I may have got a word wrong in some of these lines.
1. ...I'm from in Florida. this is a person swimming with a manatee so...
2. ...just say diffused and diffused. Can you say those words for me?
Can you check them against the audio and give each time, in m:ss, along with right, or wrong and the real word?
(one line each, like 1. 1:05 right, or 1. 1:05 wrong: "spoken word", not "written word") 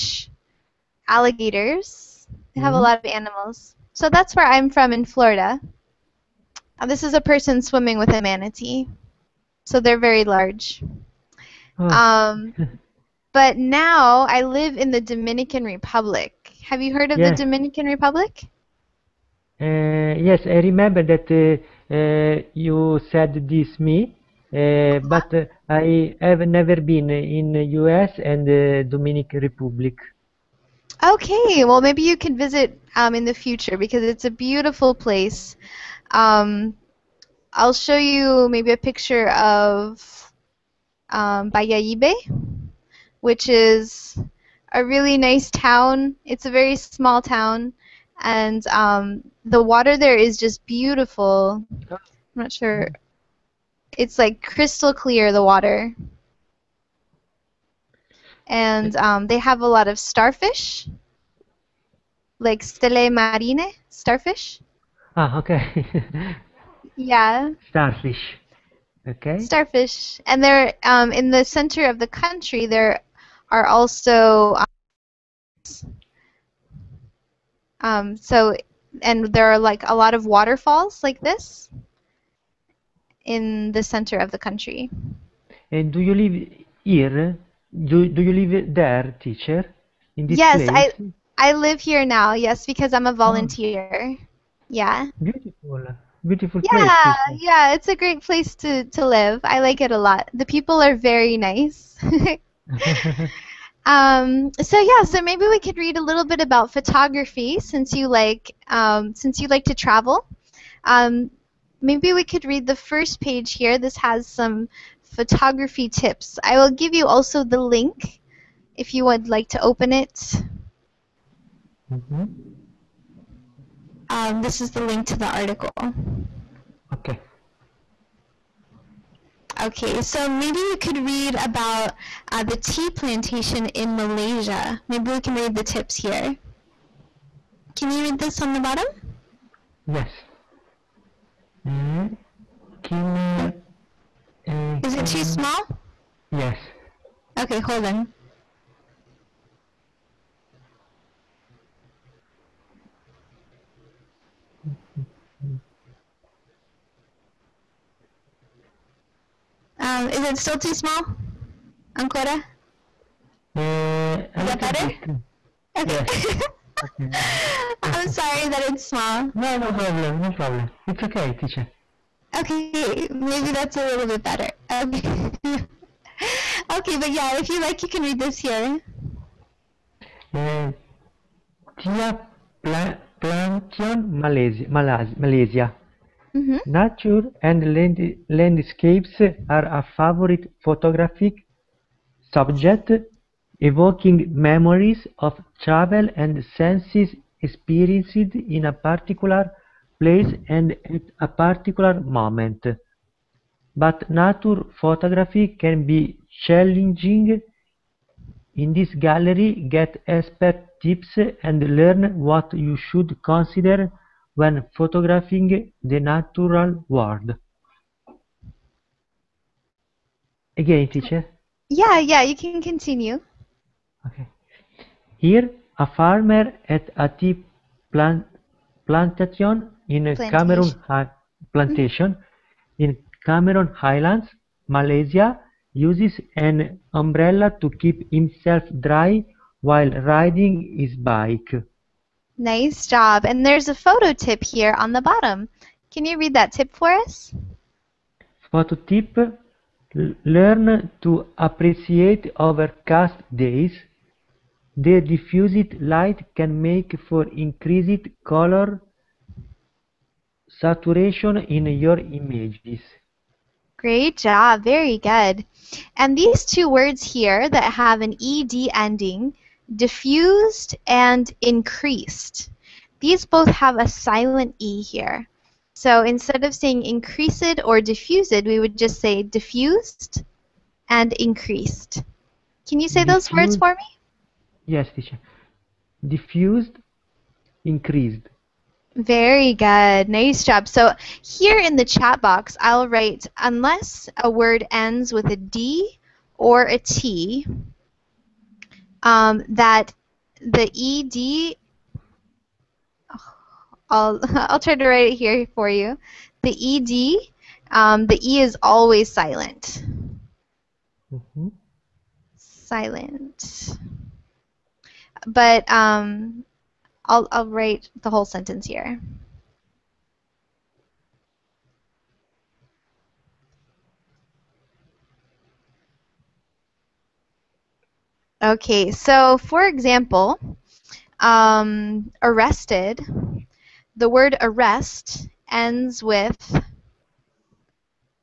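1. 0:04 right
2. 4:38 wrong: "increased", not "diffused".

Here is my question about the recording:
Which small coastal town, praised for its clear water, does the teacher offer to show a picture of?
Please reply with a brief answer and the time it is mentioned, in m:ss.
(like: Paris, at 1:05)
Bayahibe, at 0:41.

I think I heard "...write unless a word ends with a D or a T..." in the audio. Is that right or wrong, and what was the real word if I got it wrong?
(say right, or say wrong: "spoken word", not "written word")
right.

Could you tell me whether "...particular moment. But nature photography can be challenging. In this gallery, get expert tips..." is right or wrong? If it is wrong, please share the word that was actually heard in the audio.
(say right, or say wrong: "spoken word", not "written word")
right.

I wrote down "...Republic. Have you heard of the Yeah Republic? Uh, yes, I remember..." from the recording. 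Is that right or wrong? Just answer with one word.
wrong.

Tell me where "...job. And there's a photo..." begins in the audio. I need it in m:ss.
4:02.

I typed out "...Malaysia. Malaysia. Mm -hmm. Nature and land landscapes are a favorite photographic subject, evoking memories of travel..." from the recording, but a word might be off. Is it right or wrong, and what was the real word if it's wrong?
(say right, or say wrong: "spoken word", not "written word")
right.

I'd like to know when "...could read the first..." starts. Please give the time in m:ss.
1:52.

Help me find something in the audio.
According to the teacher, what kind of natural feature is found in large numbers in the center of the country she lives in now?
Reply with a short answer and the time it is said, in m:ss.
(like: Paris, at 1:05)
waterfalls, at 1:20.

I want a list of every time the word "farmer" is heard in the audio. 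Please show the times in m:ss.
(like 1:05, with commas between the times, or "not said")
3:45.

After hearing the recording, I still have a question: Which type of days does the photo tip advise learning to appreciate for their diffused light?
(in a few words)
overcast days.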